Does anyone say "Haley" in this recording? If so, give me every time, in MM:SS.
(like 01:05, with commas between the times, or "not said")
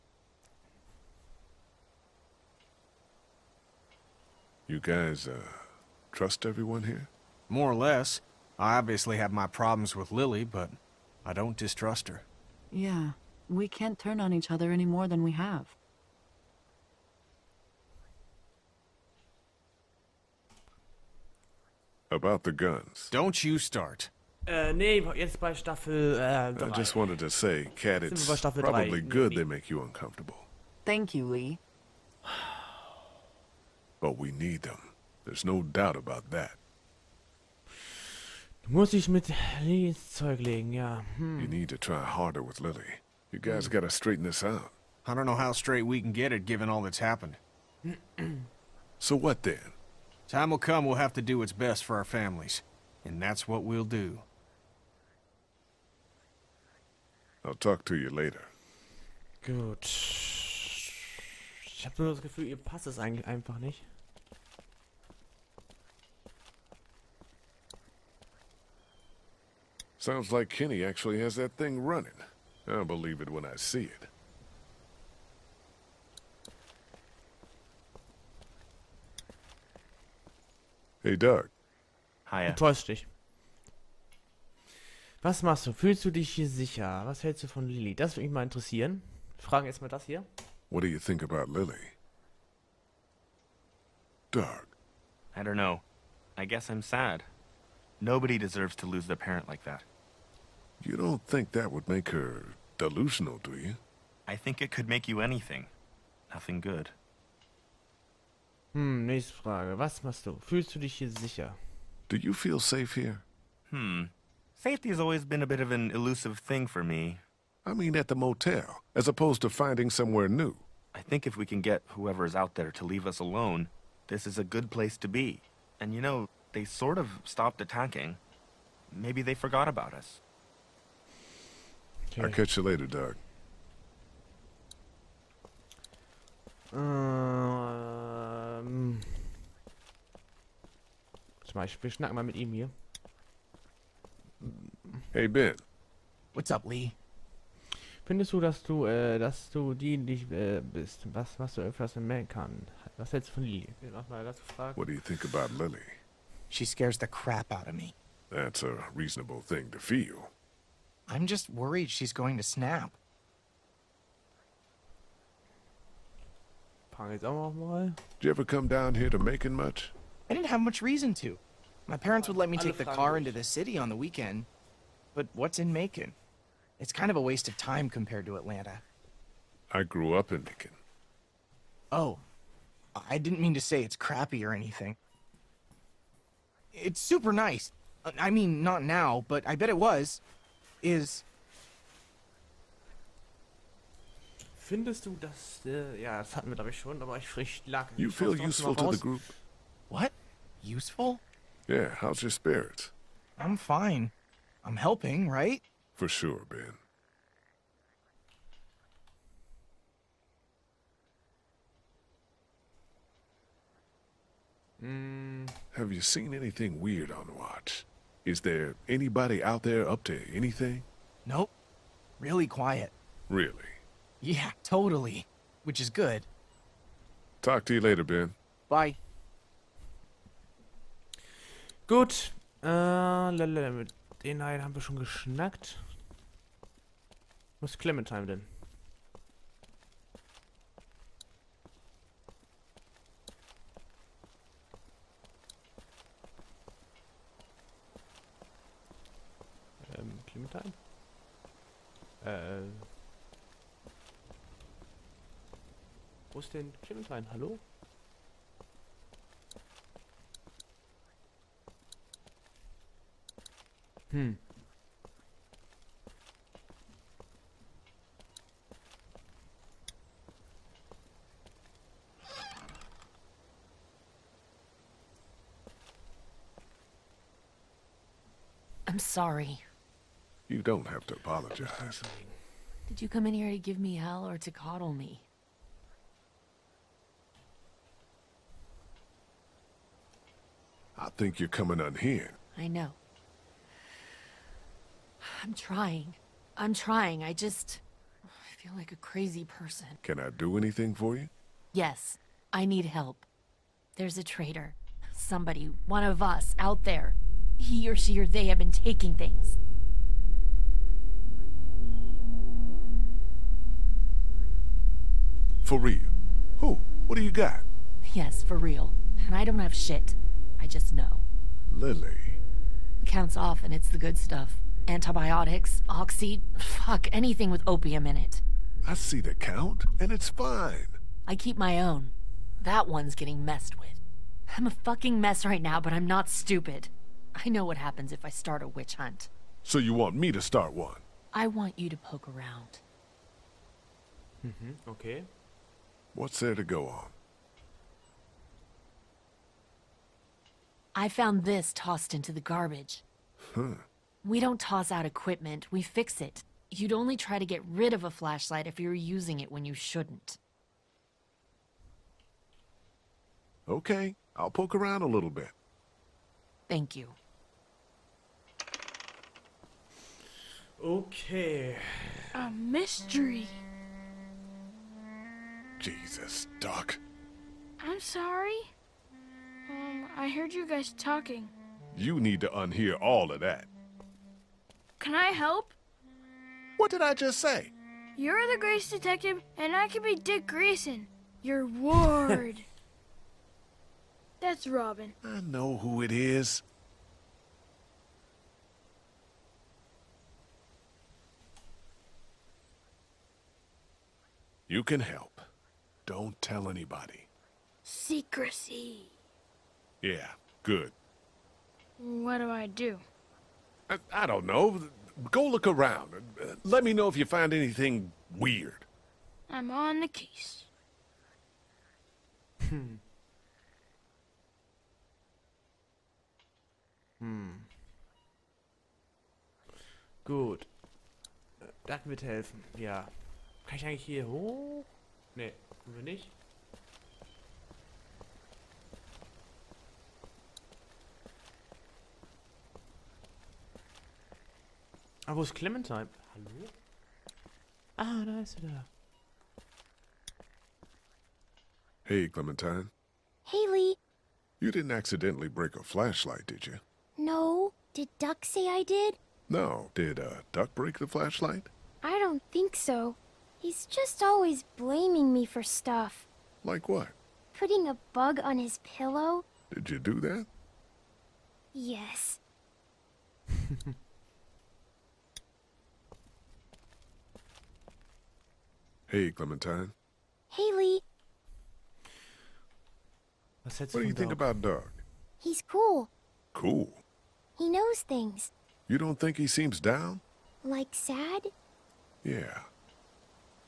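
07:33, 08:00.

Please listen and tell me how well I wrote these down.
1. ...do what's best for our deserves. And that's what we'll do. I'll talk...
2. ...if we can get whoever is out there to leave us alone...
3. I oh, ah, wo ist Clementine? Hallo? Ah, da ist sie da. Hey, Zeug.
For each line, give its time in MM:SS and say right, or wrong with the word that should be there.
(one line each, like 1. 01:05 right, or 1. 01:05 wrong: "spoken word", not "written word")
1. 00:51 wrong: "families", not "deserves"
2. 02:01 right
3. 07:25 wrong: "Clementine", not "Zeug".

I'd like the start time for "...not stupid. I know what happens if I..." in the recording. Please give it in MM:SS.
05:36.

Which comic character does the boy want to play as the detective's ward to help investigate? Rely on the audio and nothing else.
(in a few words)
Dick Grayson.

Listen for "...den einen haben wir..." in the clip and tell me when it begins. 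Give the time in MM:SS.
03:54.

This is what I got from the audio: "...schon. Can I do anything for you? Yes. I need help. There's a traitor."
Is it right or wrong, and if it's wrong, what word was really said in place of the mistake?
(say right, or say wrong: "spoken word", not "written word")
wrong: "person", not "schon".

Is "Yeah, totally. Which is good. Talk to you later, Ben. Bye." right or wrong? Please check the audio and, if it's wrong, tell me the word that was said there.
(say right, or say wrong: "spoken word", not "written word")
right.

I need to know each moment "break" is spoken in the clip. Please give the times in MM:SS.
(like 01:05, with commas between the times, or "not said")
07:35, 07:40.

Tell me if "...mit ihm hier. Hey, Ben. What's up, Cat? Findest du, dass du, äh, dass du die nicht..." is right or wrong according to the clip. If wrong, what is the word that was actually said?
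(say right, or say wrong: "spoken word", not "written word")
wrong: "Lee", not "Cat".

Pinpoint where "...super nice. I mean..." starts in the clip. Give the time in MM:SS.
03:06.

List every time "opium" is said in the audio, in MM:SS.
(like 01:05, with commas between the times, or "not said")
05:27.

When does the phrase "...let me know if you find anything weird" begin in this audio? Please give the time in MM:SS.
06:56.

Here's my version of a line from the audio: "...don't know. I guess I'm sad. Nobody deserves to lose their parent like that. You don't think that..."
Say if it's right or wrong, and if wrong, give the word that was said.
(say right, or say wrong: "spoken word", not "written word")
right.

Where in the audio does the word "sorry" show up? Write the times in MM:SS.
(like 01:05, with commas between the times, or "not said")
04:38, 06:17.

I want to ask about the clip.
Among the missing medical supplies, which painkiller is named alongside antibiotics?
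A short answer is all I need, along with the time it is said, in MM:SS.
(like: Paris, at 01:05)
Oxy, at 05:25.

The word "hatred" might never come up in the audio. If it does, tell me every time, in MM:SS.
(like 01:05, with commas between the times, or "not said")
not said.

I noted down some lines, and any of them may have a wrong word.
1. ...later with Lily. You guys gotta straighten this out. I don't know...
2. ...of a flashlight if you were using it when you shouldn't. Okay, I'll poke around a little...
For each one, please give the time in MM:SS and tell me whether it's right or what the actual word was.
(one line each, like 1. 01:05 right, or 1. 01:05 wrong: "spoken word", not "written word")
1. 00:42 wrong: "harder", not "later"
2. 05:57 right.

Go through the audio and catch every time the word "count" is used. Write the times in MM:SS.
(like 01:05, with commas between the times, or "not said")
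05:23, 05:29.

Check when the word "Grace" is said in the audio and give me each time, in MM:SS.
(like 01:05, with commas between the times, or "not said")
06:28.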